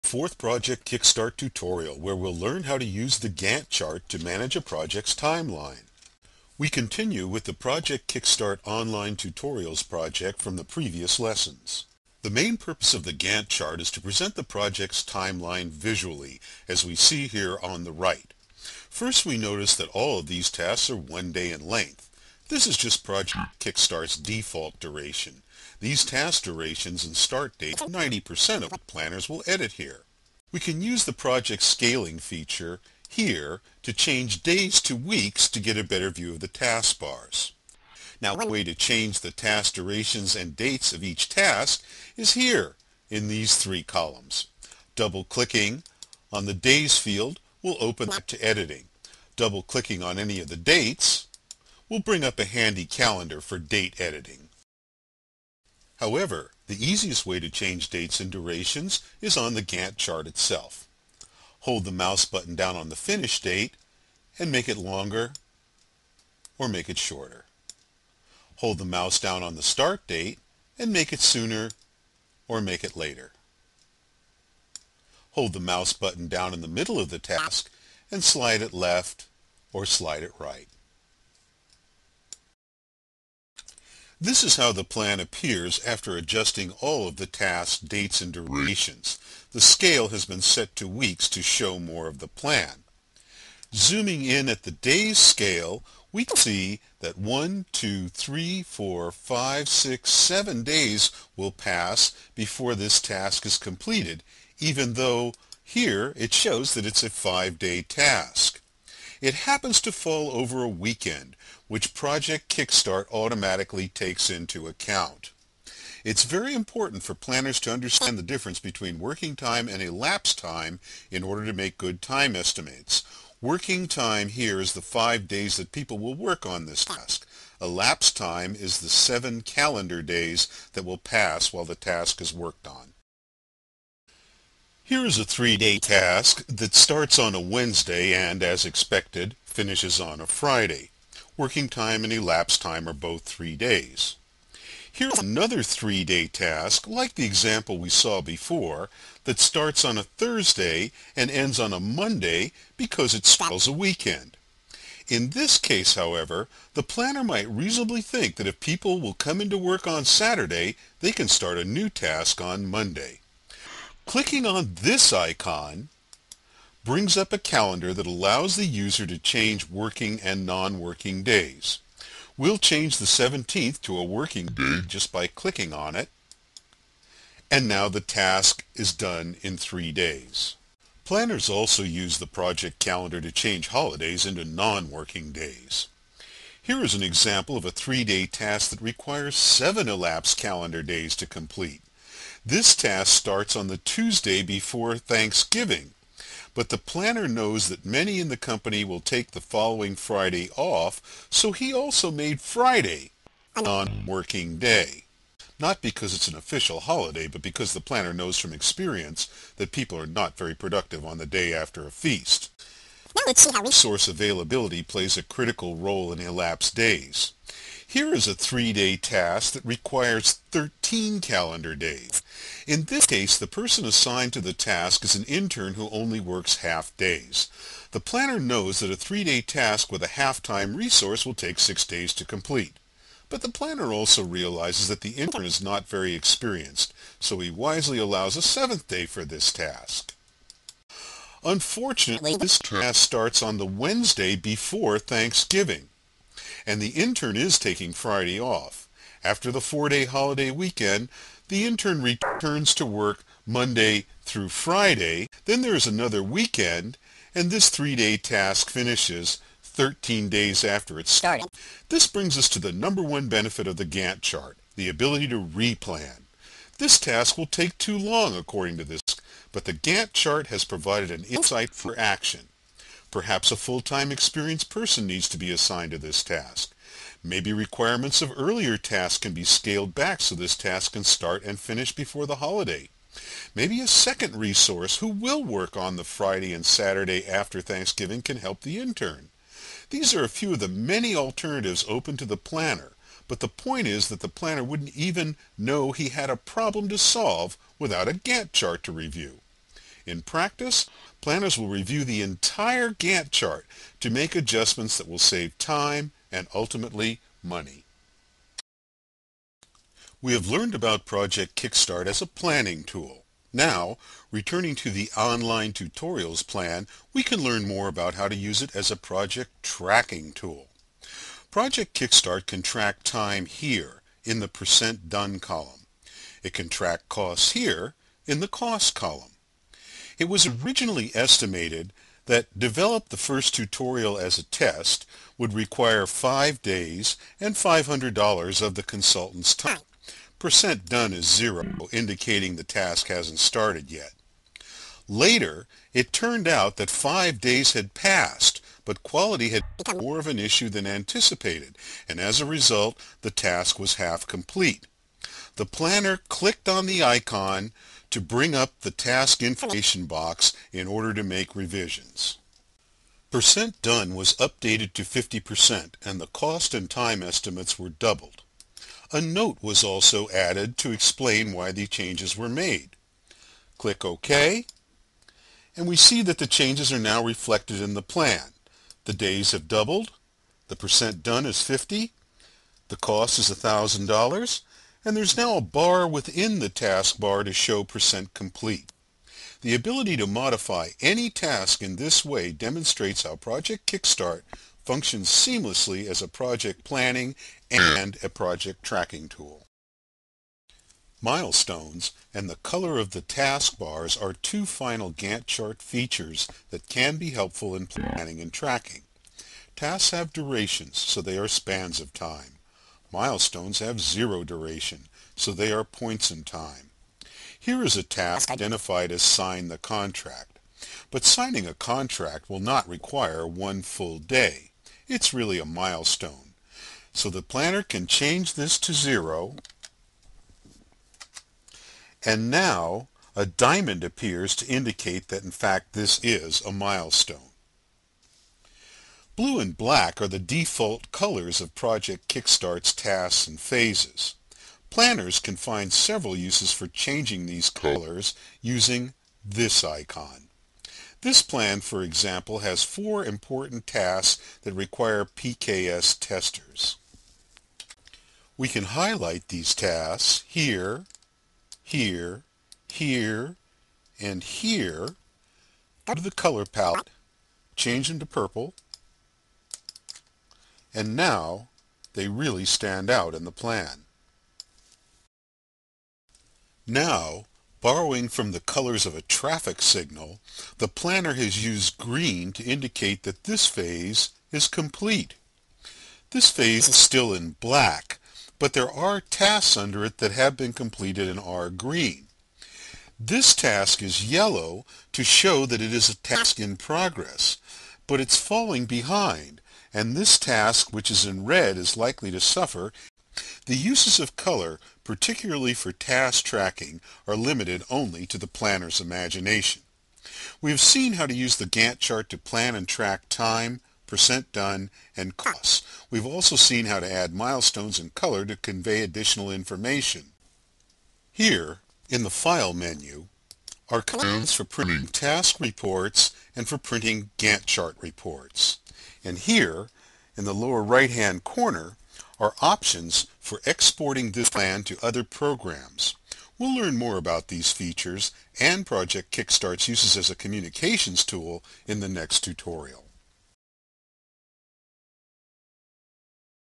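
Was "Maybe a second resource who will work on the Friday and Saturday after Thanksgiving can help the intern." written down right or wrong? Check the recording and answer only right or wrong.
right.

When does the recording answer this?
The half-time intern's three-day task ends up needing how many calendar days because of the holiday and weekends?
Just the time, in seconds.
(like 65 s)
220 s.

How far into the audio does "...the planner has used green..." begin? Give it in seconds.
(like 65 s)
480 s.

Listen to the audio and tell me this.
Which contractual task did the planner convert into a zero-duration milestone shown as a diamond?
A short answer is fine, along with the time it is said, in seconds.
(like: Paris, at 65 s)
Sign the contract, at 419 s.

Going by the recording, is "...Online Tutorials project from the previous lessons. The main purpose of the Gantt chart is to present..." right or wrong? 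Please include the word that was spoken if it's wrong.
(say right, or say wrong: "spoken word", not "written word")
right.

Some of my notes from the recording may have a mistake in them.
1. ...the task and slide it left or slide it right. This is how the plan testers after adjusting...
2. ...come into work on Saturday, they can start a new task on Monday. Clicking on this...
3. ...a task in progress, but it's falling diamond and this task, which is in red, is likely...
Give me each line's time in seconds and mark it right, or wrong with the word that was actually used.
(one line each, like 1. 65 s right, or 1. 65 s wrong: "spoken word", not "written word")
1. 77 s wrong: "appears", not "testers"
2. 159 s right
3. 496 s wrong: "behind", not "diamond".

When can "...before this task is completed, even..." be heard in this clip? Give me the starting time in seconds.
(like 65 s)
102 s.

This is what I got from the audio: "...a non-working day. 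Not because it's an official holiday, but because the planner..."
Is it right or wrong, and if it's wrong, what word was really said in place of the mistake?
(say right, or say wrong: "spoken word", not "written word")
right.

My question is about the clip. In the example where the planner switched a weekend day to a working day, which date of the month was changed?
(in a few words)
17th.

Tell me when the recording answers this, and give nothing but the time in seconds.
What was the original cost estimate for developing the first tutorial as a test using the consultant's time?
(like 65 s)
337 s.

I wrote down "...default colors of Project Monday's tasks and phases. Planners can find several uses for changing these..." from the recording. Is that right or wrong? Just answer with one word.
wrong.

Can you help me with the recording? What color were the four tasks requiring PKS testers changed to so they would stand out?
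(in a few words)
Purple.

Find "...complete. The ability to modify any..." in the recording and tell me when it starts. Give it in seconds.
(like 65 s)
388 s.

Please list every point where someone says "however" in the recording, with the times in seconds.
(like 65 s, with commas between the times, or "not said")
56 s, 155 s.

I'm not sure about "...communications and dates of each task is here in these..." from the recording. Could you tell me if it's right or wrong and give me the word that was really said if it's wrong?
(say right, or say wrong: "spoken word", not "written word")
wrong: "durations", not "communications".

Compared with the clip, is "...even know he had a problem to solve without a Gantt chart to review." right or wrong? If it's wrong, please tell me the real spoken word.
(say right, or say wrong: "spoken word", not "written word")
right.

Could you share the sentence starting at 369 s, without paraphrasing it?
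A note was also added to explain why the changes were made.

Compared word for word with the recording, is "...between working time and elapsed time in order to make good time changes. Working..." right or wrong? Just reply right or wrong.
wrong.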